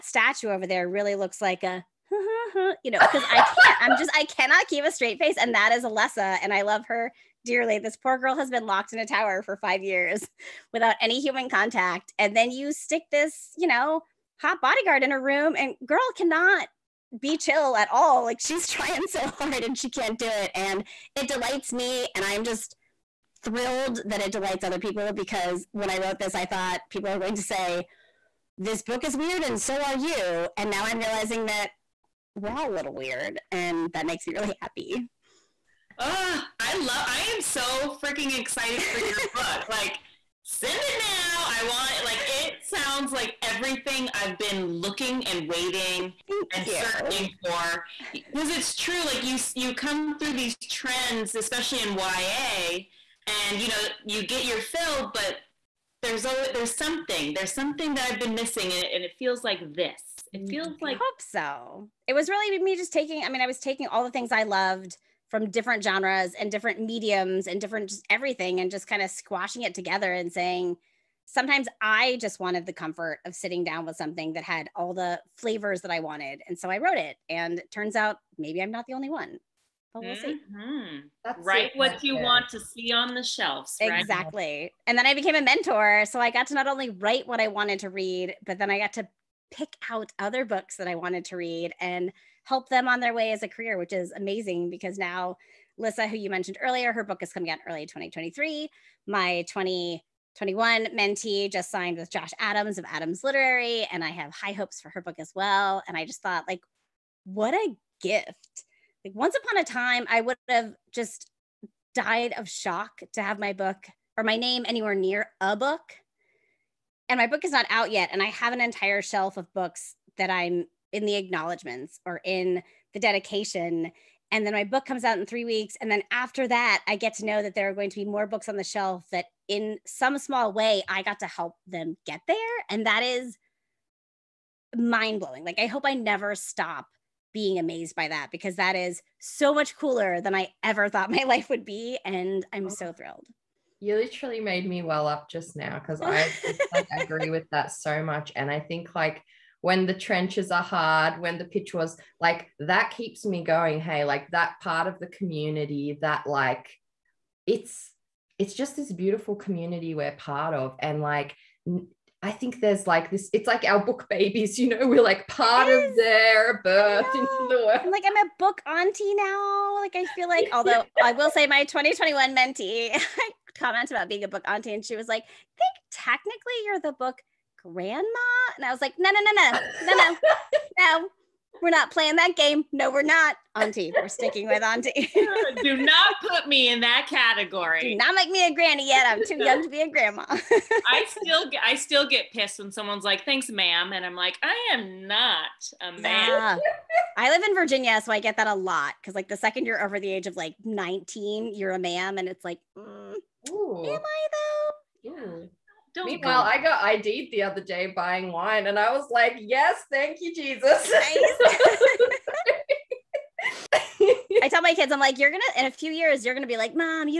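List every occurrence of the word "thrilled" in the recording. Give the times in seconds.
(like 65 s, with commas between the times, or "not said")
23 s, 142 s.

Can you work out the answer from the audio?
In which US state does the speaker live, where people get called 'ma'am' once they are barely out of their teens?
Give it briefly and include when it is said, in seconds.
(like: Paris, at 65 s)
Virginia, at 197 s.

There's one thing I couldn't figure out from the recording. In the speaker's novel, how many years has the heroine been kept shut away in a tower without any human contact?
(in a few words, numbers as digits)
5.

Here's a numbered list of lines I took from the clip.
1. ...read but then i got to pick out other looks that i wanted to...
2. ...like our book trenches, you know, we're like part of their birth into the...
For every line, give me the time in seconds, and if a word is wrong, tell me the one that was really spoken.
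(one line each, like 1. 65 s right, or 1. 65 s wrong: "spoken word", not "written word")
1. 87 s wrong: "books", not "looks"
2. 163 s wrong: "babies", not "trenches".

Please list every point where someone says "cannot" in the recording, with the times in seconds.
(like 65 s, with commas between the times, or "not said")
4 s, 16 s.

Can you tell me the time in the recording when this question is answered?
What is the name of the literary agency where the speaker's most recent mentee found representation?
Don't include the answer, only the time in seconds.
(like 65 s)
102 s.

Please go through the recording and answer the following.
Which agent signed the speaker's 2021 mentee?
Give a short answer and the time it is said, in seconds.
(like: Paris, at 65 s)
Josh Adams, at 102 s.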